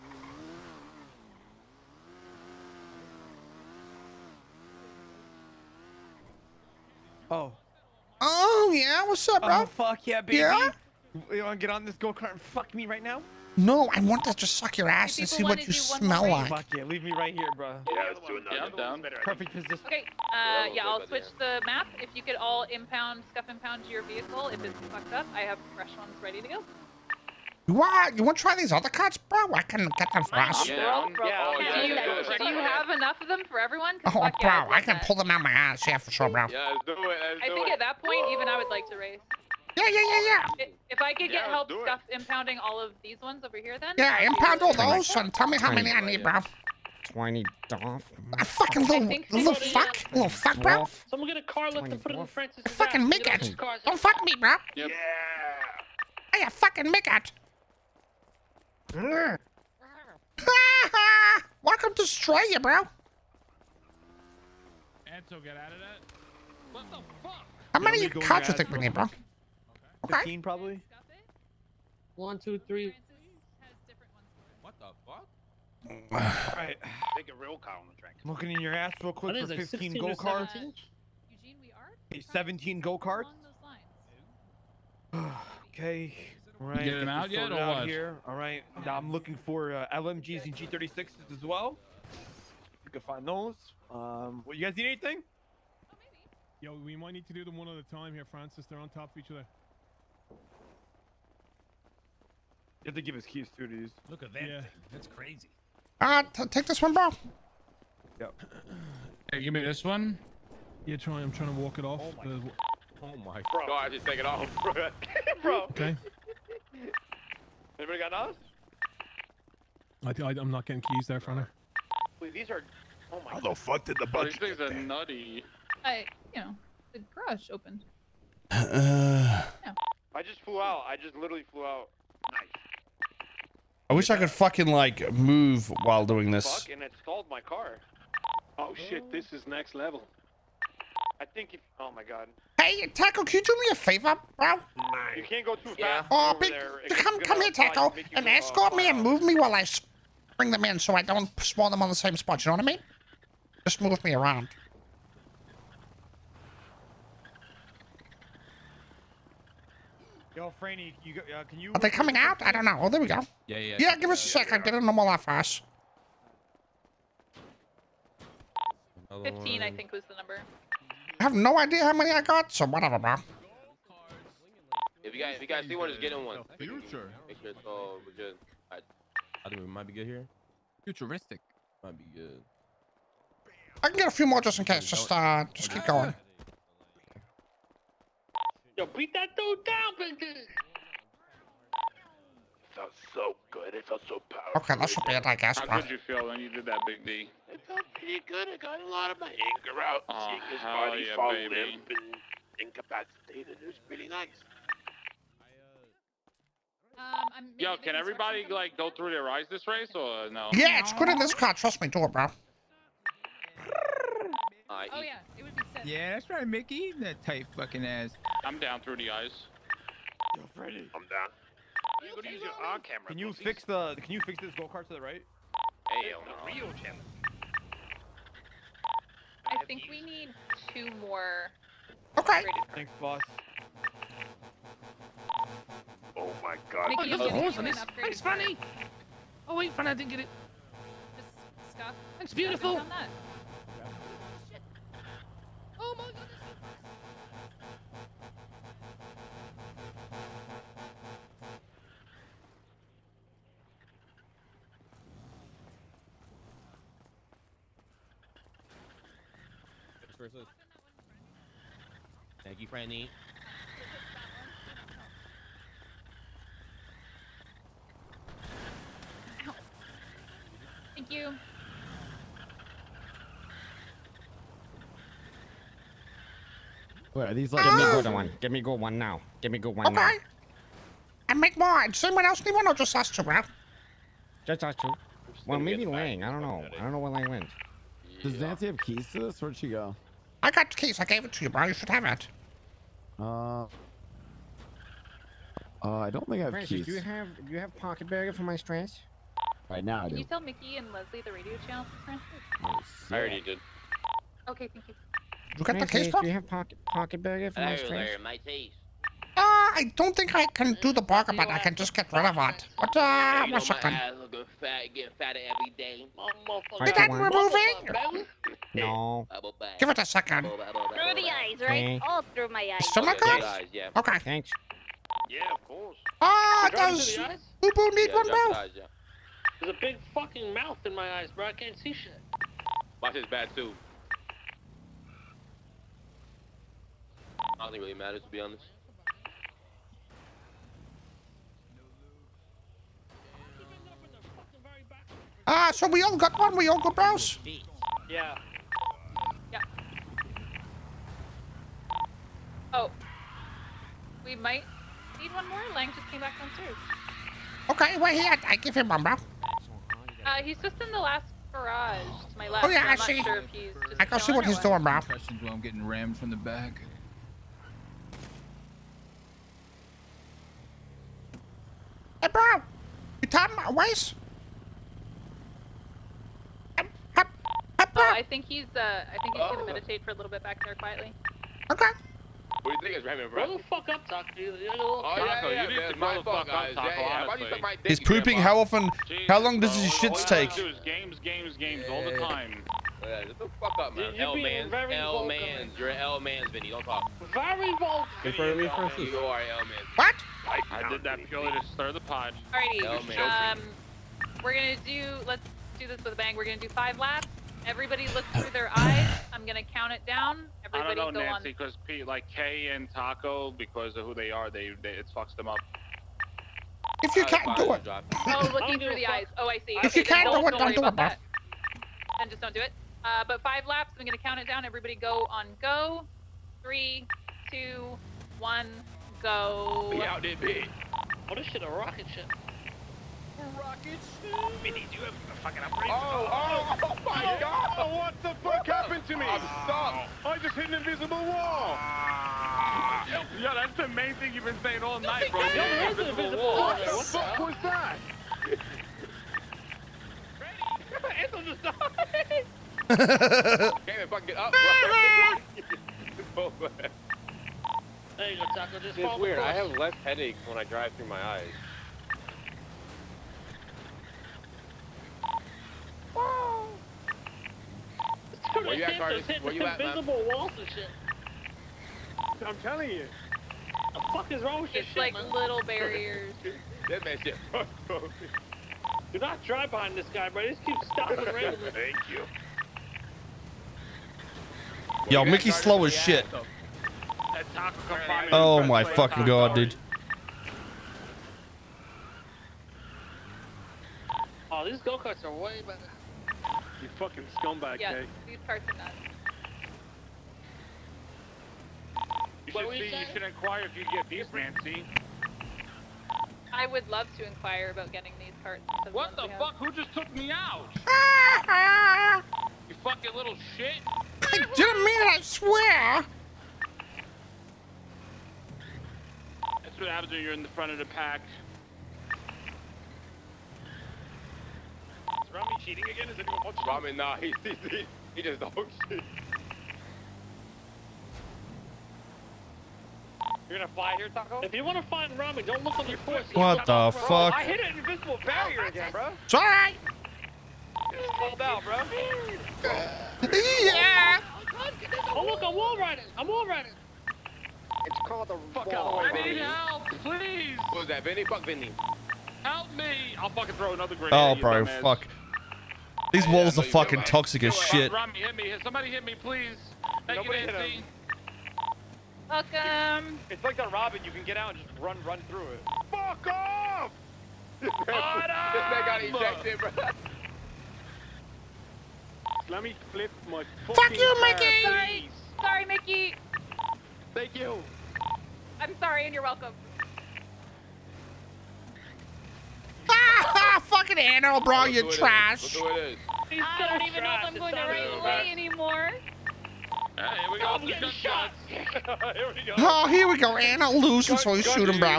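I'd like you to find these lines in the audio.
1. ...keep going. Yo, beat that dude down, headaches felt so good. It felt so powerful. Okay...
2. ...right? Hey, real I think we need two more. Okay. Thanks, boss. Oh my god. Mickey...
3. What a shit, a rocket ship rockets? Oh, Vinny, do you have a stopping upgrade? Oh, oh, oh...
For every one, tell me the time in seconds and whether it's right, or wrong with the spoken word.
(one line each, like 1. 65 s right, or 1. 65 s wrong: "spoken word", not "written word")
1. 185 s wrong: "bitches", not "headaches"
2. 224 s right
3. 431 s wrong: "fucking", not "stopping".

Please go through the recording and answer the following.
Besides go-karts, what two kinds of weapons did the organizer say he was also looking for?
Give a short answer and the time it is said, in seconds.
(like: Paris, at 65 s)
LMGs and G36s, at 89 s.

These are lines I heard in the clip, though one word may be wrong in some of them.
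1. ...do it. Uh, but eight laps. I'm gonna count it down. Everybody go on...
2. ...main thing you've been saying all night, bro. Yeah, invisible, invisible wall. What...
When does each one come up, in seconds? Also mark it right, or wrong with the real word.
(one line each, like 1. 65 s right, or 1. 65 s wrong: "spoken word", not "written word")
1. 422 s wrong: "five", not "eight"
2. 443 s right.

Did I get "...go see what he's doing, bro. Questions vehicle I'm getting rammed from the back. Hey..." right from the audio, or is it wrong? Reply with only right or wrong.
wrong.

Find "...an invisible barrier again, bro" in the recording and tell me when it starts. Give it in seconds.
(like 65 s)
537 s.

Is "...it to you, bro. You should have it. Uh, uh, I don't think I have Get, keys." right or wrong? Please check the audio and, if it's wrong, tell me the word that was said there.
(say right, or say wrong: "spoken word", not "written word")
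wrong: "Francis", not "Get".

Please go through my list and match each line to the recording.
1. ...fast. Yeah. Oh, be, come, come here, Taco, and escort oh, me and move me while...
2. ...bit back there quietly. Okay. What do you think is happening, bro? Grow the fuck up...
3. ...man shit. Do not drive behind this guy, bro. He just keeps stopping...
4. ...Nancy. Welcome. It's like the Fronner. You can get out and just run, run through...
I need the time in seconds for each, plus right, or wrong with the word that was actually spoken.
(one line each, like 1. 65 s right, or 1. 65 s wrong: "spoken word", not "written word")
1. 145 s right
2. 380 s right
3. 477 s right
4. 560 s wrong: "Robin", not "Fronner".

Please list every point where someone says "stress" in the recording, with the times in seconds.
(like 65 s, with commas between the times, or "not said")
298 s, 307 s.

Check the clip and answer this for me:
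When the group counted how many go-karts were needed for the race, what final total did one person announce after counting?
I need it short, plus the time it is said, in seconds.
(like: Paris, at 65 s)
17, at 82 s.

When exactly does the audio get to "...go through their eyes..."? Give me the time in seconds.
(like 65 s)
208 s.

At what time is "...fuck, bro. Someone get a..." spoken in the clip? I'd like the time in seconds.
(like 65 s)
50 s.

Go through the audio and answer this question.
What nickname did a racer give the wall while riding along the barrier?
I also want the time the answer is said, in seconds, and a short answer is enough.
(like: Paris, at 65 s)
the fuck wall, at 548 s.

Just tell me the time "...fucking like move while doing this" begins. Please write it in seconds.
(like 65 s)
134 s.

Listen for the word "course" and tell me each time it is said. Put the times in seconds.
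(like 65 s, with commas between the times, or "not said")
325 s, 535 s.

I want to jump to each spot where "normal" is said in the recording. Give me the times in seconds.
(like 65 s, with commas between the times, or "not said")
164 s.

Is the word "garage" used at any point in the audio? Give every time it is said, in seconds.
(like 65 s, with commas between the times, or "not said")
127 s, 361 s.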